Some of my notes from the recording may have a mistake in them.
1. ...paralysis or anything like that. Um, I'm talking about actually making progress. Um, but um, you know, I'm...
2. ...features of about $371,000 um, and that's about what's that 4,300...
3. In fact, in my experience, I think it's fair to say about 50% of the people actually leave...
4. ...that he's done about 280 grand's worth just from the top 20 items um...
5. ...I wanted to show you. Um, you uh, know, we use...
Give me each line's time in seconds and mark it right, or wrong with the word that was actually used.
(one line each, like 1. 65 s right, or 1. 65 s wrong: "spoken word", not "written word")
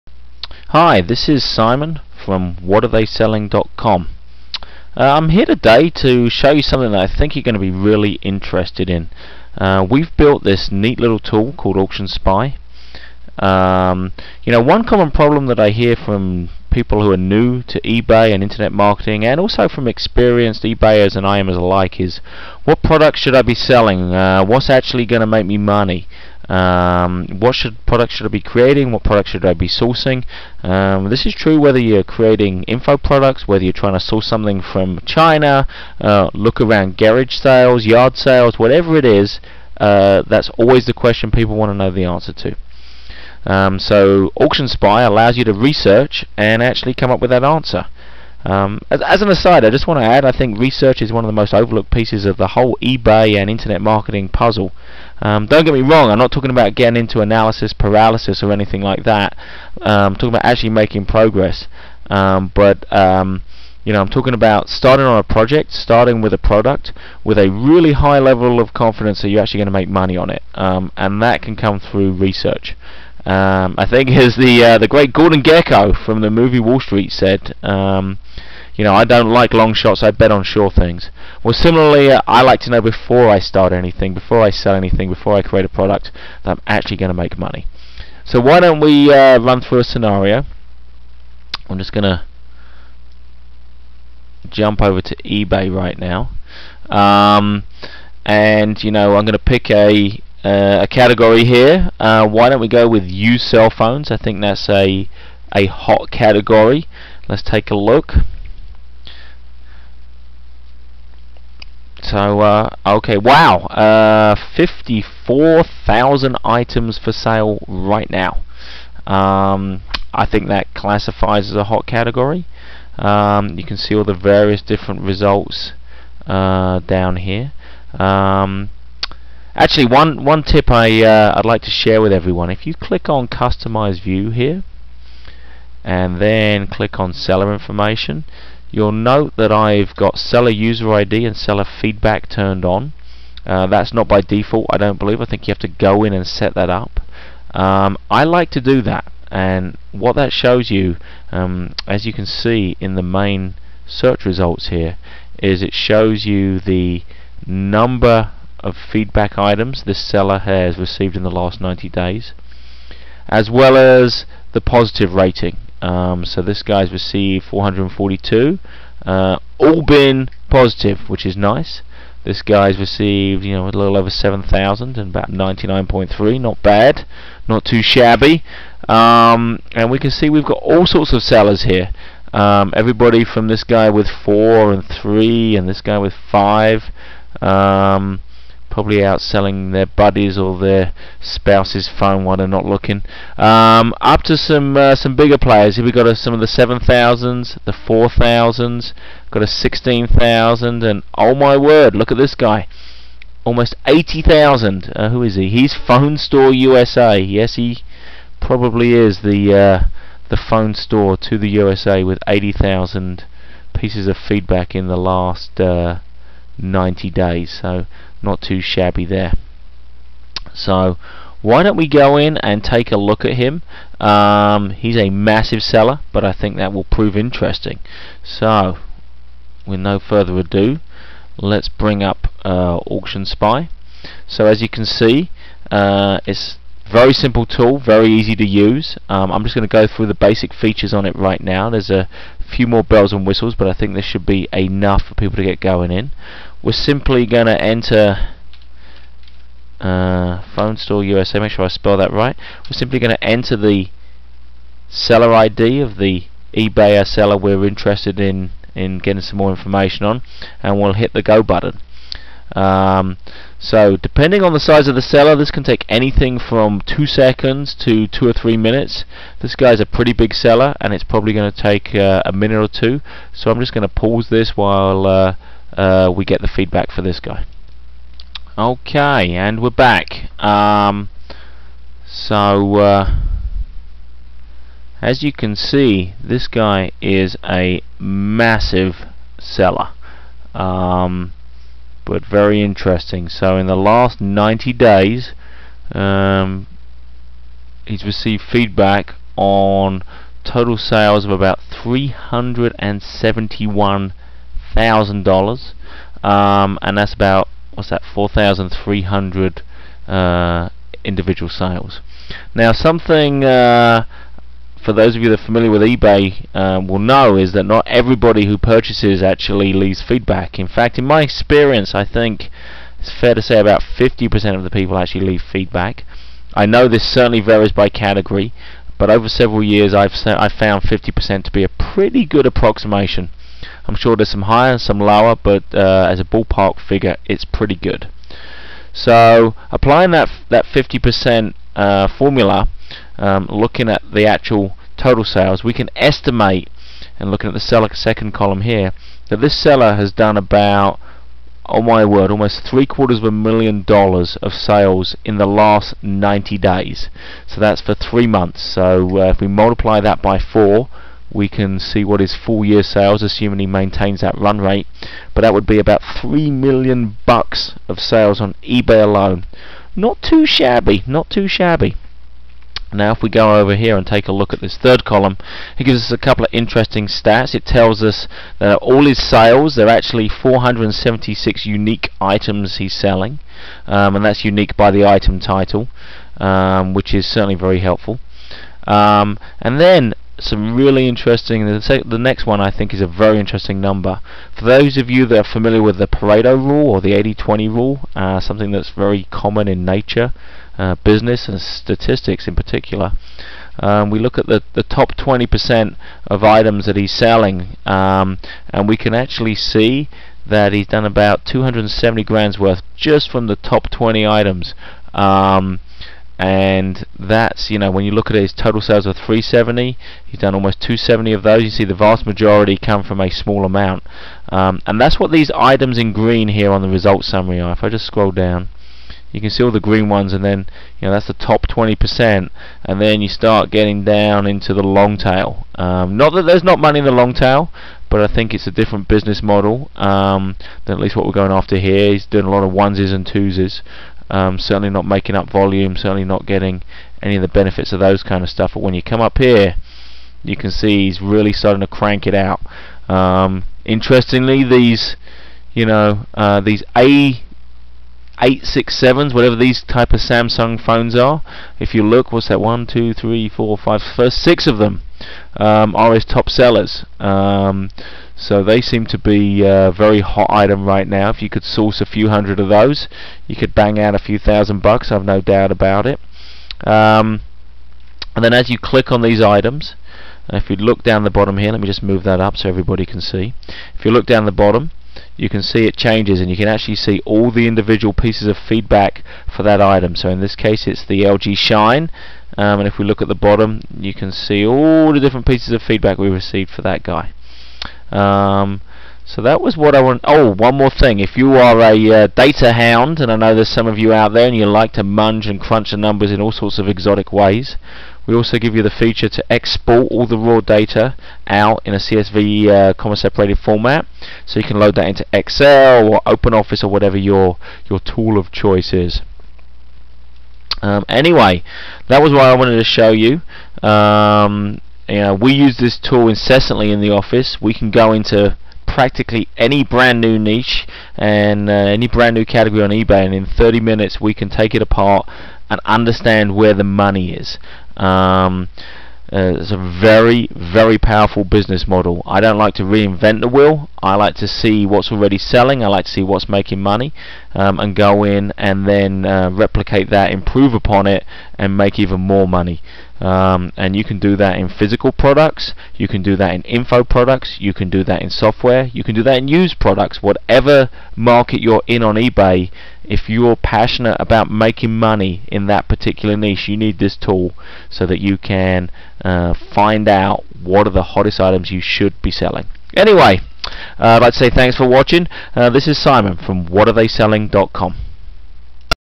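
1. 57 s right
2. 300 s wrong: "sales", not "features"
3. 320 s right
4. 410 s wrong: "270", not "280"
5. 522 s right.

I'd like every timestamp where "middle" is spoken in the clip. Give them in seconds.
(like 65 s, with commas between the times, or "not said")
not said.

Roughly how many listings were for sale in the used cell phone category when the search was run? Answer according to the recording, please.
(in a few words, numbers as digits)
54,000.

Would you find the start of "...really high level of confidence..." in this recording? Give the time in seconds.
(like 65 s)
67 s.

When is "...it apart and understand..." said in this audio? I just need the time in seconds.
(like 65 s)
534 s.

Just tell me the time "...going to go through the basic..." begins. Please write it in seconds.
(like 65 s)
239 s.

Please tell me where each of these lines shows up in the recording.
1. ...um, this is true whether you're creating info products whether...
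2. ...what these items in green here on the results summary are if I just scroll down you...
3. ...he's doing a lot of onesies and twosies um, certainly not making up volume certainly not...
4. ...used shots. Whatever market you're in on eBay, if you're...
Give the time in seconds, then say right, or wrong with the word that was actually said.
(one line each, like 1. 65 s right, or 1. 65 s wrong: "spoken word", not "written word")
1. 30 s right
2. 425 s right
3. 442 s right
4. 559 s wrong: "products", not "shots".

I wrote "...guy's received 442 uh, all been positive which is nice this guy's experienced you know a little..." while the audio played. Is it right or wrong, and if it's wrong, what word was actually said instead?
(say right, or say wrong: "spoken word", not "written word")
wrong: "received", not "experienced".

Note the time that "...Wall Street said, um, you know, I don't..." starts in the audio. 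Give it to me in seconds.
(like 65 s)
76 s.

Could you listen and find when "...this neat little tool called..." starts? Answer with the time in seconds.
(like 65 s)
10 s.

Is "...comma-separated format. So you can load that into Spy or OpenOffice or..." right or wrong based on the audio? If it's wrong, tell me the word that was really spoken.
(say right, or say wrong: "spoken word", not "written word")
wrong: "Excel", not "Spy".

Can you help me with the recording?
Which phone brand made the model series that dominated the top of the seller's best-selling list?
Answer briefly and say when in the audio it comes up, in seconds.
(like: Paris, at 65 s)
Samsung, at 460 s.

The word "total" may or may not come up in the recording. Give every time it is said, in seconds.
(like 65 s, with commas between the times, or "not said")
300 s, 344 s, 418 s.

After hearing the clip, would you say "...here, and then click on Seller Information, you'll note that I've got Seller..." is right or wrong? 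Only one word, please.
right.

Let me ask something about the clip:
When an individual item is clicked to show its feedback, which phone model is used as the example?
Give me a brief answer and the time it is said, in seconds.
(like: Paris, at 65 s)
LG Shine, at 491 s.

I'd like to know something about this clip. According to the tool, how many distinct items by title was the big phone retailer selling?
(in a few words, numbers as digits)
476.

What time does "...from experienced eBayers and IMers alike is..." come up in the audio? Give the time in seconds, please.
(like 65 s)
19 s.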